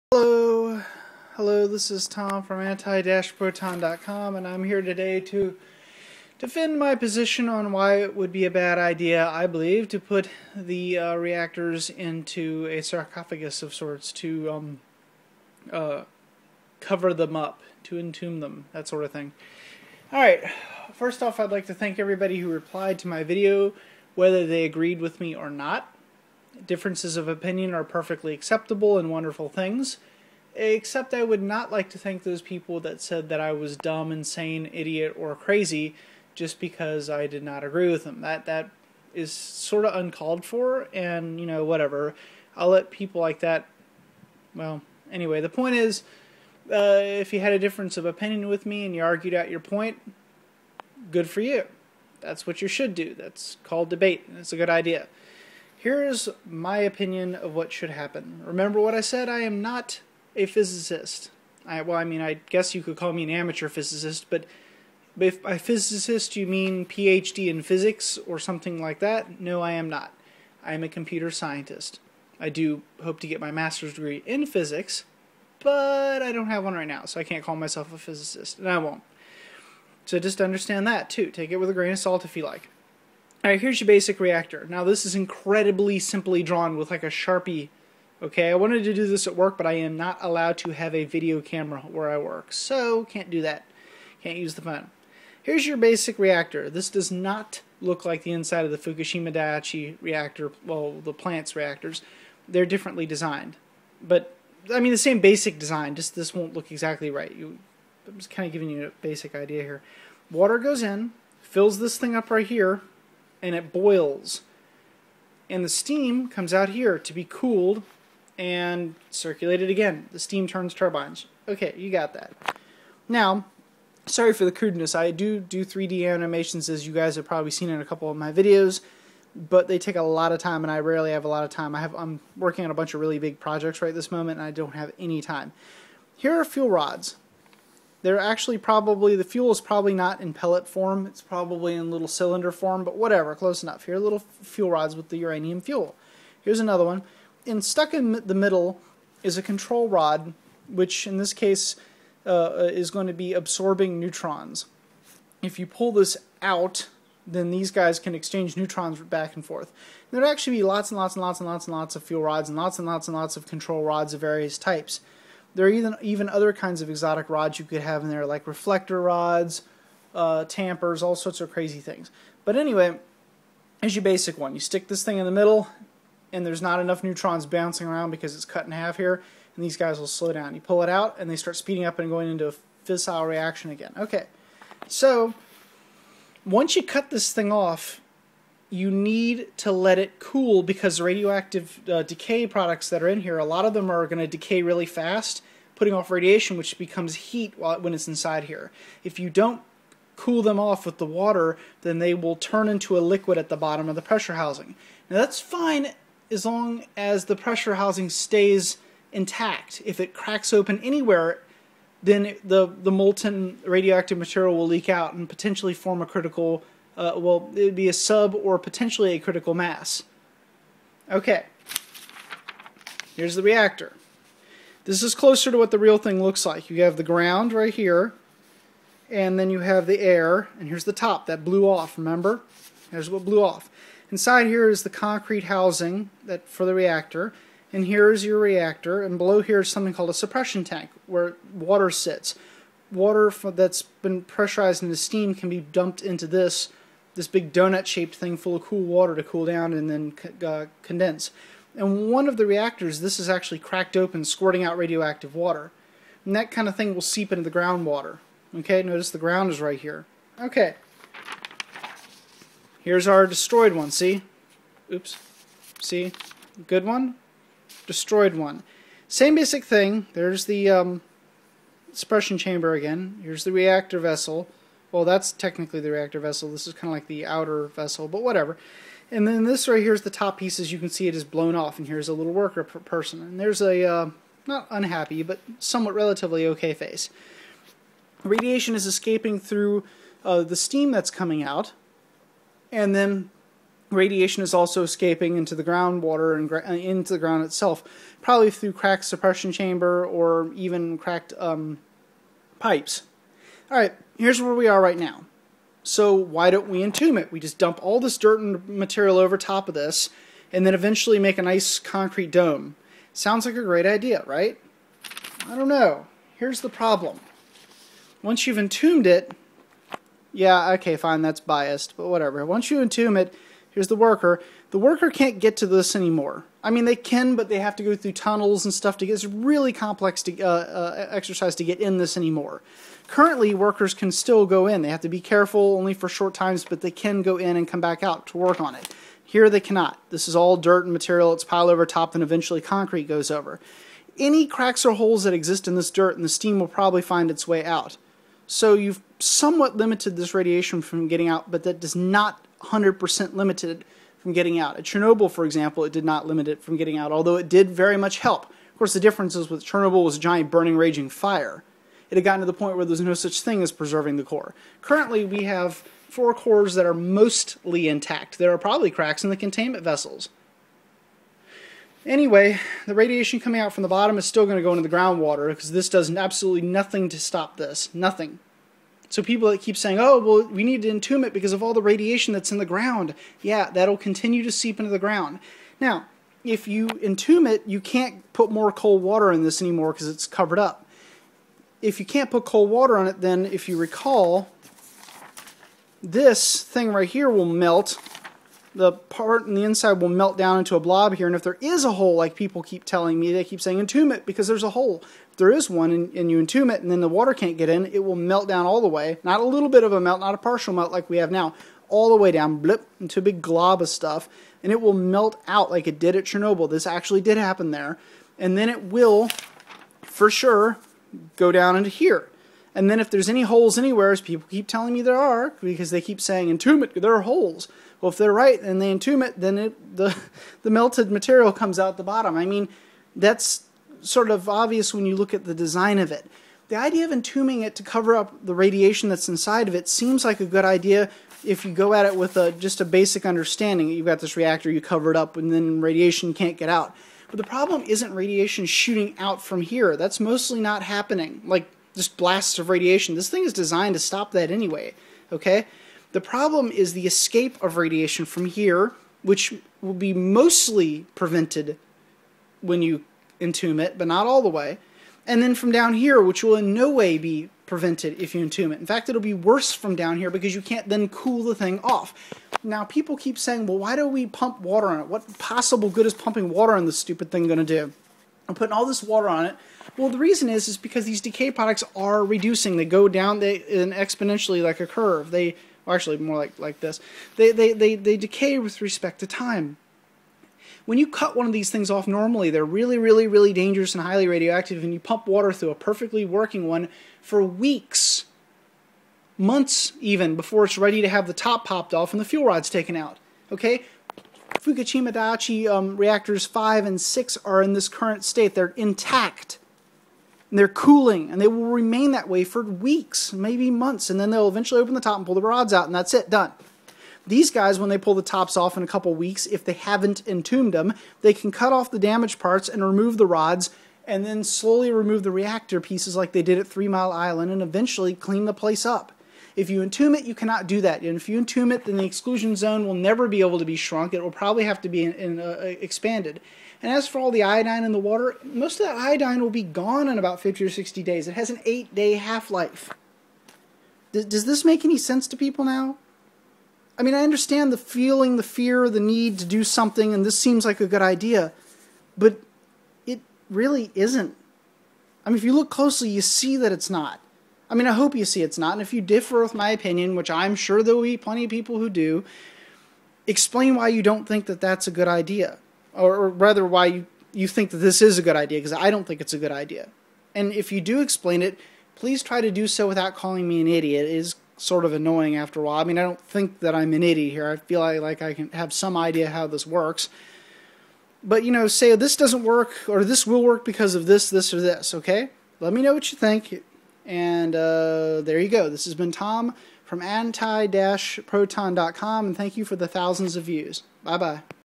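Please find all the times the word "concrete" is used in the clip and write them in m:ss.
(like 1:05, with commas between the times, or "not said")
3:54, 5:11, 5:42.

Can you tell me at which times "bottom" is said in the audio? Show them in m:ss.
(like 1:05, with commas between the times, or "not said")
3:23, 6:13, 7:12.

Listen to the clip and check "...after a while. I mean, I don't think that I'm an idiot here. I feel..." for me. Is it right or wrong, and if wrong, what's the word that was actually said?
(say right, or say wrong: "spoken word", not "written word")
right.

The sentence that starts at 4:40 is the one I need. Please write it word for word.
As you can see, it is blown off, and here's a little worker person.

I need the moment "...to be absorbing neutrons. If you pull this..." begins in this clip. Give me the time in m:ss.
2:33.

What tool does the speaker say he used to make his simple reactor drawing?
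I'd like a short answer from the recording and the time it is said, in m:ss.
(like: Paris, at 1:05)
Sharpie, at 1:27.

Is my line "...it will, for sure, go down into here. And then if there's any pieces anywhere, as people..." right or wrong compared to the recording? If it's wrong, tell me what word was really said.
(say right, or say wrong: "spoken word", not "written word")
wrong: "holes", not "pieces".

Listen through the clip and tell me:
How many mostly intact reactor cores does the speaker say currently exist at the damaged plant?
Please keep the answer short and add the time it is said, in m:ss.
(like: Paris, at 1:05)
4, at 6:06.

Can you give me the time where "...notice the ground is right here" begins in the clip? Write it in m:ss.
4:18.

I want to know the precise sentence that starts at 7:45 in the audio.
And then from down here, which will in no way be prevented if you entomb it.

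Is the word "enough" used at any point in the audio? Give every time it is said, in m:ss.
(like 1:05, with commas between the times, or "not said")
2:23, 2:56.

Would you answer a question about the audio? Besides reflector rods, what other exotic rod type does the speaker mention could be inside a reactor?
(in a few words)
Tampers.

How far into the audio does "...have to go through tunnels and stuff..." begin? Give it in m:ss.
5:27.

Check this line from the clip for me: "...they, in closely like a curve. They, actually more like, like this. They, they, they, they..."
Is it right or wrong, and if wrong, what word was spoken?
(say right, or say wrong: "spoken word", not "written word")
wrong: "exponentially", not "closely".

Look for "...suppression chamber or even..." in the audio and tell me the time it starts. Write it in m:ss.
4:59.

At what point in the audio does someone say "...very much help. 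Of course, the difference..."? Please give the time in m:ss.
5:57.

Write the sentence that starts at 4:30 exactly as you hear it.
There's the um, suppression chamber again.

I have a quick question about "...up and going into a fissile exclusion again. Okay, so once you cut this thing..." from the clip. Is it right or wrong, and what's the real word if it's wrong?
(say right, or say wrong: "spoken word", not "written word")
wrong: "reaction", not "exclusion".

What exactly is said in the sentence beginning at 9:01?
It has an eight day half life.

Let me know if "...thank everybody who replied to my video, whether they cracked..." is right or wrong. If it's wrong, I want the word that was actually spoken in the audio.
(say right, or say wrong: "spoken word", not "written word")
wrong: "agreed", not "cracked".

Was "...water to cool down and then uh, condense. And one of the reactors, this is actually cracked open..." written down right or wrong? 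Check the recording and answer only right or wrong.
right.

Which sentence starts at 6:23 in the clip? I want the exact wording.
Yeah, that'll continue to seep into the ground.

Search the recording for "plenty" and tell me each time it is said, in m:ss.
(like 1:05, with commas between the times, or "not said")
9:21.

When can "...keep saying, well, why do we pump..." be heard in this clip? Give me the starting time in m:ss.
7:53.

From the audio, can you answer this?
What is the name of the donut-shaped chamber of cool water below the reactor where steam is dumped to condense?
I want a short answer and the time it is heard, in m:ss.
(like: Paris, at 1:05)
Suppression tank, at 4:00.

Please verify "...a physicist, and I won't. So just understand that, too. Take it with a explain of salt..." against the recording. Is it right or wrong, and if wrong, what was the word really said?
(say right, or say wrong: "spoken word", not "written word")
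wrong: "grain", not "explain".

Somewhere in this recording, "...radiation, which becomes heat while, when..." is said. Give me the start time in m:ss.
3:16.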